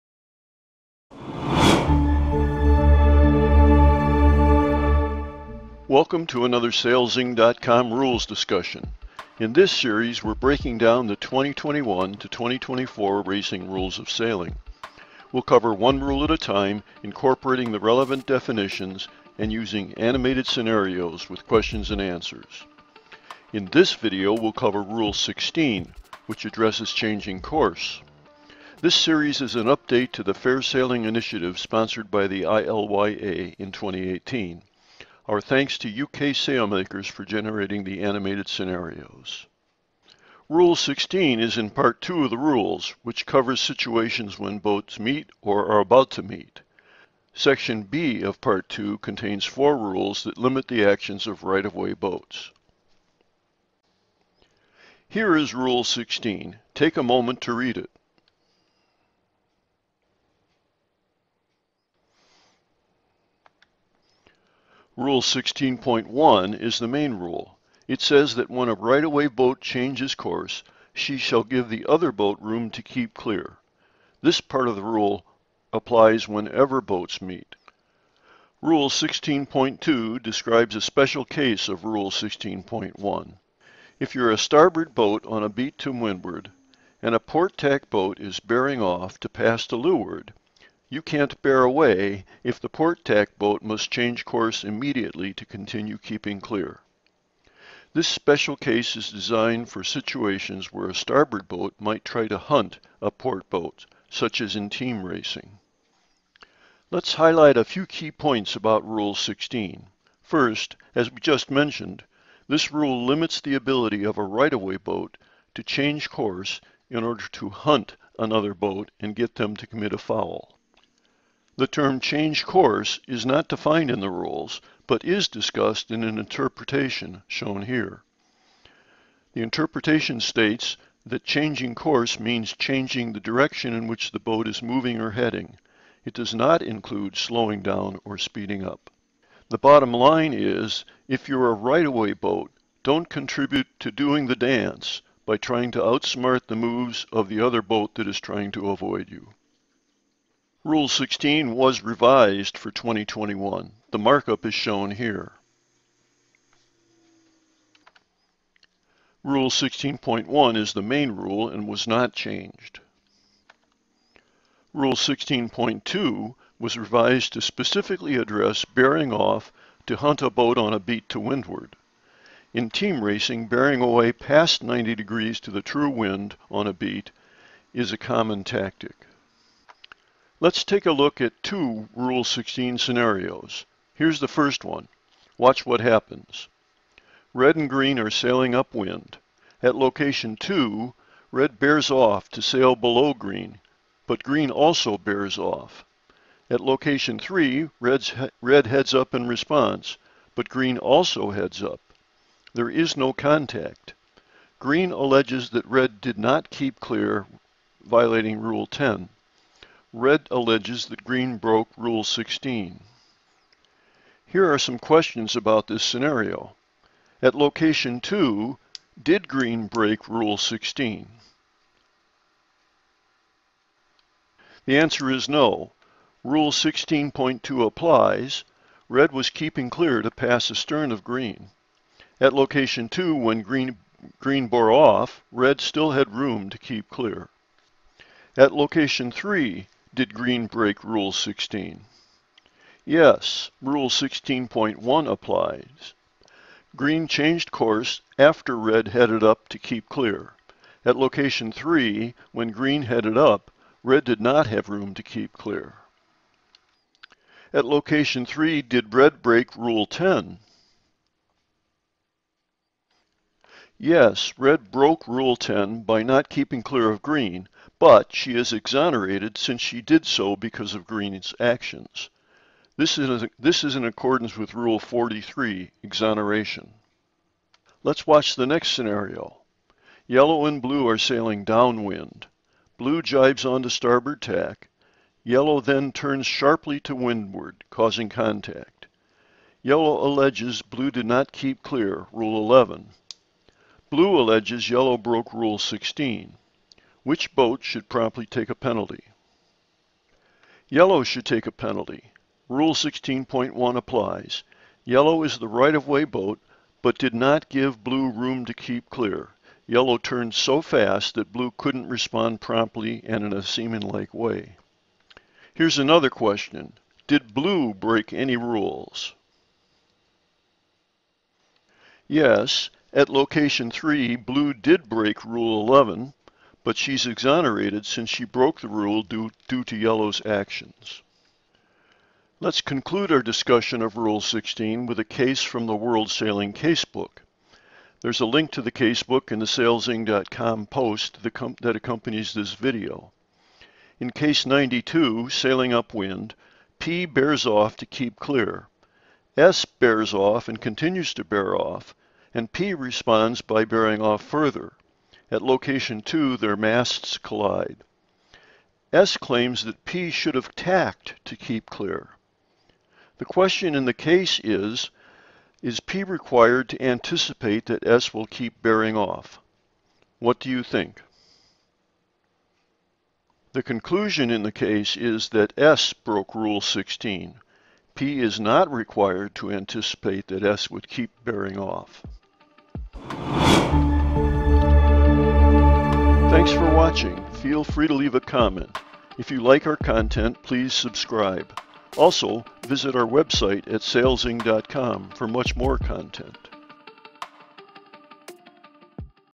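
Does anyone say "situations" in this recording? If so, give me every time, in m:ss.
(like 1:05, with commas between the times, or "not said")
0:43, 1:39.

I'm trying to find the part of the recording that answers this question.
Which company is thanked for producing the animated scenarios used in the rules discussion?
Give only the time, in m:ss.
0:36.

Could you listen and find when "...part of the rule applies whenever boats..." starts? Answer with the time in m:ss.
1:14.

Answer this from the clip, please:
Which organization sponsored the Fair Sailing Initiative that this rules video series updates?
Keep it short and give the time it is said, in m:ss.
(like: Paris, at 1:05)
ILYA, at 0:32.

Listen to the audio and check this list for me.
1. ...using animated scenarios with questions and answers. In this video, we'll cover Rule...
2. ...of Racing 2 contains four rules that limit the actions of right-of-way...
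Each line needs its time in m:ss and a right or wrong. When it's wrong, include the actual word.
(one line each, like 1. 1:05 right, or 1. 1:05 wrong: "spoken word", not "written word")
1. 0:19 right
2. 0:48 wrong: "Part", not "Racing".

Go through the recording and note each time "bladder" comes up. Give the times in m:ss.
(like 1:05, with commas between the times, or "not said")
not said.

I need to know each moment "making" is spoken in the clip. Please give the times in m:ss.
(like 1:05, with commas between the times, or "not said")
not said.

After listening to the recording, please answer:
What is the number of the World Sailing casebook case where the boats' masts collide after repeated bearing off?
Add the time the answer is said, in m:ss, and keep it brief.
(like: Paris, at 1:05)
92, at 5:44.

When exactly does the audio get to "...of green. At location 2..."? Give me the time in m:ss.
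3:50.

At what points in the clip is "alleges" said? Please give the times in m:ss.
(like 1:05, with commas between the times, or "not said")
3:24, 3:30, 4:50, 4:54.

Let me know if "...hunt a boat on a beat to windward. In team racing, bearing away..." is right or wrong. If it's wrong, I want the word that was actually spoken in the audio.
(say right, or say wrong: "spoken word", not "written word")
right.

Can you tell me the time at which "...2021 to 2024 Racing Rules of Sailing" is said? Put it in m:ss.
0:11.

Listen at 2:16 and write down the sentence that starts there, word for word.
It does not include slowing down or speeding up.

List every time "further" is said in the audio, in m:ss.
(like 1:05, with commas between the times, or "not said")
5:54.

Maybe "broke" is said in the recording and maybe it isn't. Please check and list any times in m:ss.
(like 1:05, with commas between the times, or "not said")
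3:31, 4:24, 4:54, 5:28, 6:15.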